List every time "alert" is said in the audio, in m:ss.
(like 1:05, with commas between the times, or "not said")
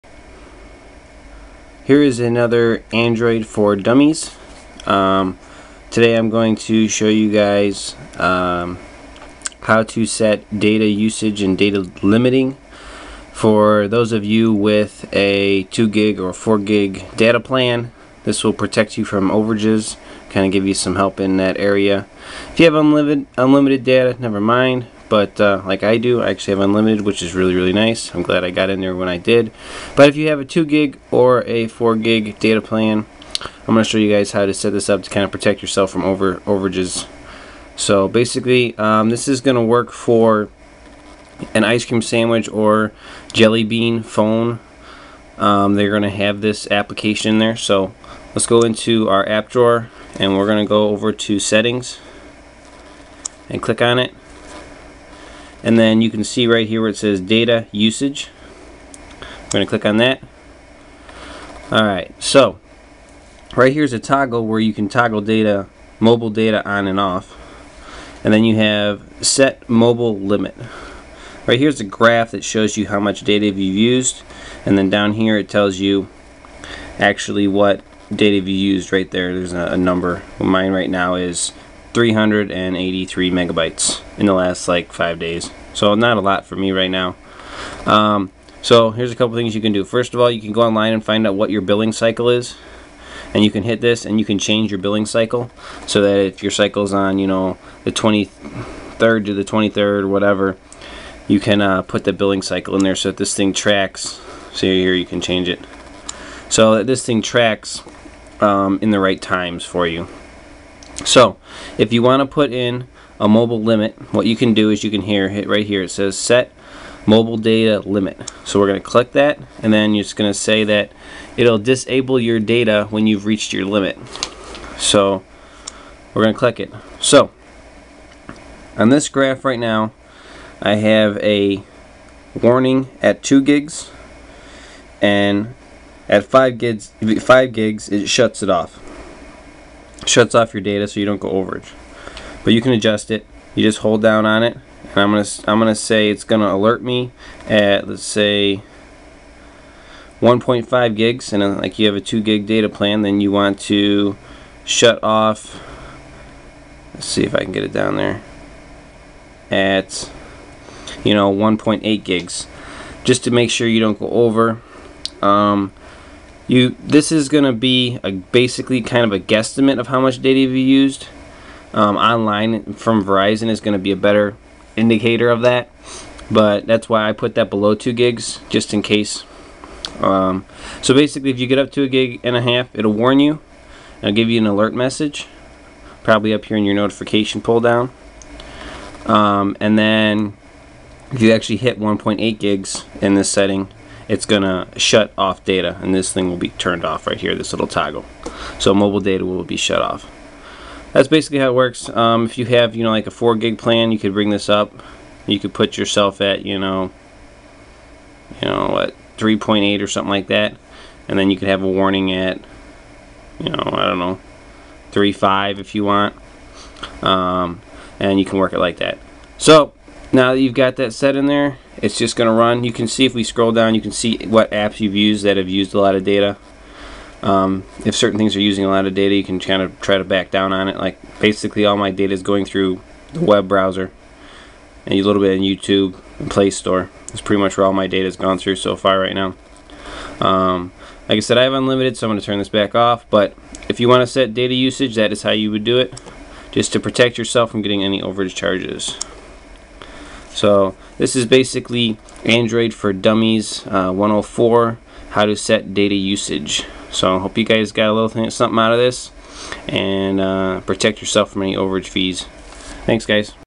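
2:26, 3:04.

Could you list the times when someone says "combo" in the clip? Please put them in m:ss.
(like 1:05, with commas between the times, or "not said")
not said.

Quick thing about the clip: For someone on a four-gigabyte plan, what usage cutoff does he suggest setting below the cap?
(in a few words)
3.8.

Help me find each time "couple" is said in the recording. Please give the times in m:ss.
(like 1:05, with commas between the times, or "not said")
1:29.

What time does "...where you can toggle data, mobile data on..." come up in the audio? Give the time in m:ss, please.
1:04.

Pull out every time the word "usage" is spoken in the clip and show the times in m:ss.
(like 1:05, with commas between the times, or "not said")
0:10, 0:57, 4:04, 4:15.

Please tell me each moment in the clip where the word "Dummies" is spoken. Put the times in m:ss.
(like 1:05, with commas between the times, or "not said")
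0:03, 4:12.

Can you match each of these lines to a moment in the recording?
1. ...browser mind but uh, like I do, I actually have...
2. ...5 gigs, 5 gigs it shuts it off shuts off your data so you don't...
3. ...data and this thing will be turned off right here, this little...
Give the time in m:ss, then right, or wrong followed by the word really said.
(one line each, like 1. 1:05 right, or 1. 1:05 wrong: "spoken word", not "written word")
1. 0:24 wrong: "never", not "browser"
2. 2:16 right
3. 3:15 right.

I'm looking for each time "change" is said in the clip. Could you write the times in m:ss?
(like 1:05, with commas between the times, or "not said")
1:34, 1:45.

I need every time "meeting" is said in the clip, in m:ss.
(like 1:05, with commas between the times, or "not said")
not said.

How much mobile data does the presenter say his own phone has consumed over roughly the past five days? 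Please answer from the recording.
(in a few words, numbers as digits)
383 megabytes.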